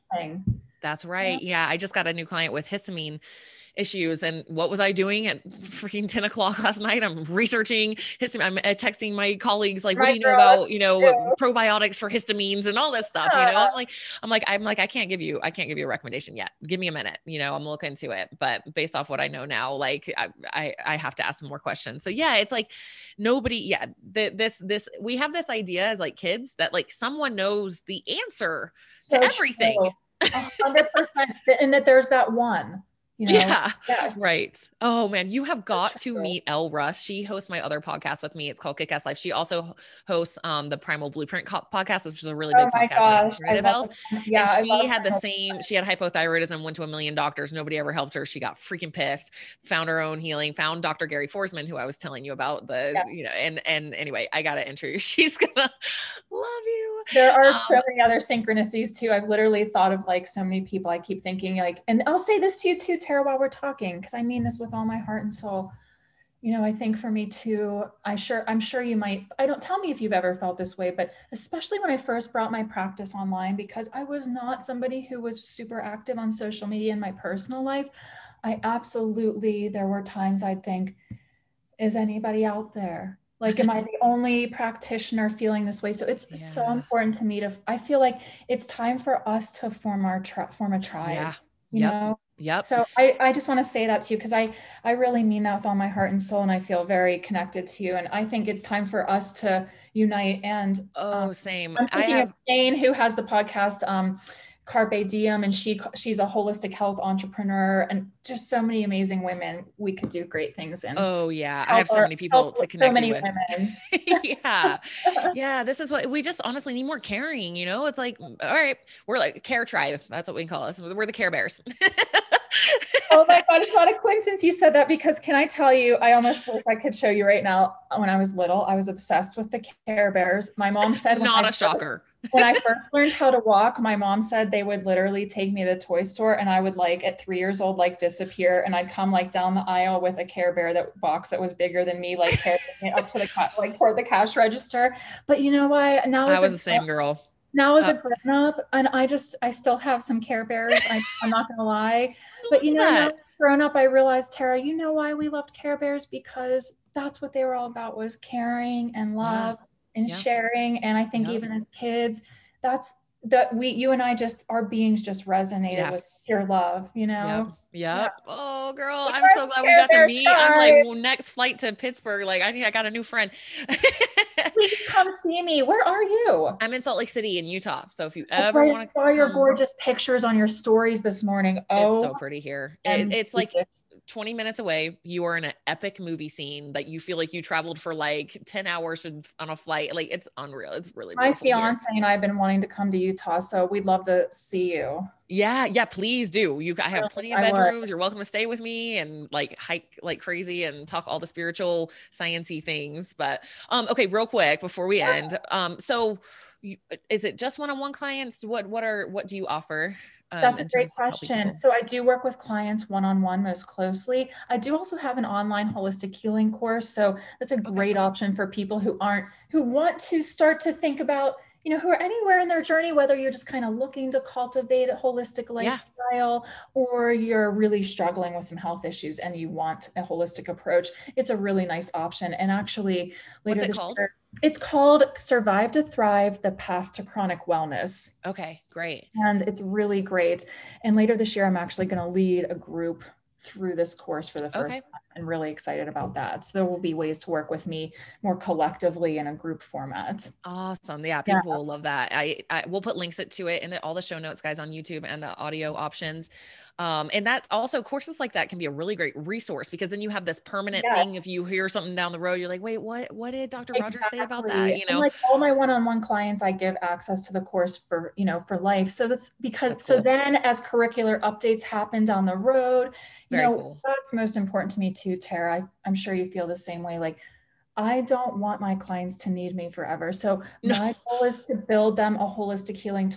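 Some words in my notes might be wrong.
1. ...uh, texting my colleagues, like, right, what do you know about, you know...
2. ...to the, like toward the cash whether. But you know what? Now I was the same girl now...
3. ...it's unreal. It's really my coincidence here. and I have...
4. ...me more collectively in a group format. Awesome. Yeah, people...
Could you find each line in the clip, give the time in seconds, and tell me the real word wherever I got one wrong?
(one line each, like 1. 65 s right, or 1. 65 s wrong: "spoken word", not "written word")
1. 8 s right
2. 143 s wrong: "register", not "whether"
3. 190 s wrong: "fiance", not "coincidence"
4. 247 s right.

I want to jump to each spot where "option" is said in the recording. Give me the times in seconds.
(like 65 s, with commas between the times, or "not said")
218 s, 231 s, 255 s.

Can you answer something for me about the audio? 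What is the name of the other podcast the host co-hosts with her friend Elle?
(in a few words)
Kick Ass Life.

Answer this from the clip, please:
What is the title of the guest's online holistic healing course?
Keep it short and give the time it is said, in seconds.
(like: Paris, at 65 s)
Survive to Thrive, at 235 s.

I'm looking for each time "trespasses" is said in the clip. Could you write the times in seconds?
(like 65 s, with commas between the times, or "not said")
not said.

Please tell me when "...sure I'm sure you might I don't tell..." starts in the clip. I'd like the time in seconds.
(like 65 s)
68 s.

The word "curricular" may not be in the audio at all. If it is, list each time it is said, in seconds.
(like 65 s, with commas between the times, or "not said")
270 s.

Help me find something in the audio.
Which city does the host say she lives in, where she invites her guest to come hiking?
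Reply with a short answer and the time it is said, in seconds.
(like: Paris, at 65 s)
Salt Lake City, at 176 s.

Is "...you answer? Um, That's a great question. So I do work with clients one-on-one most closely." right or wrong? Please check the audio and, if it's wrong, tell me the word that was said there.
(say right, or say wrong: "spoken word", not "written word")
wrong: "offer", not "answer".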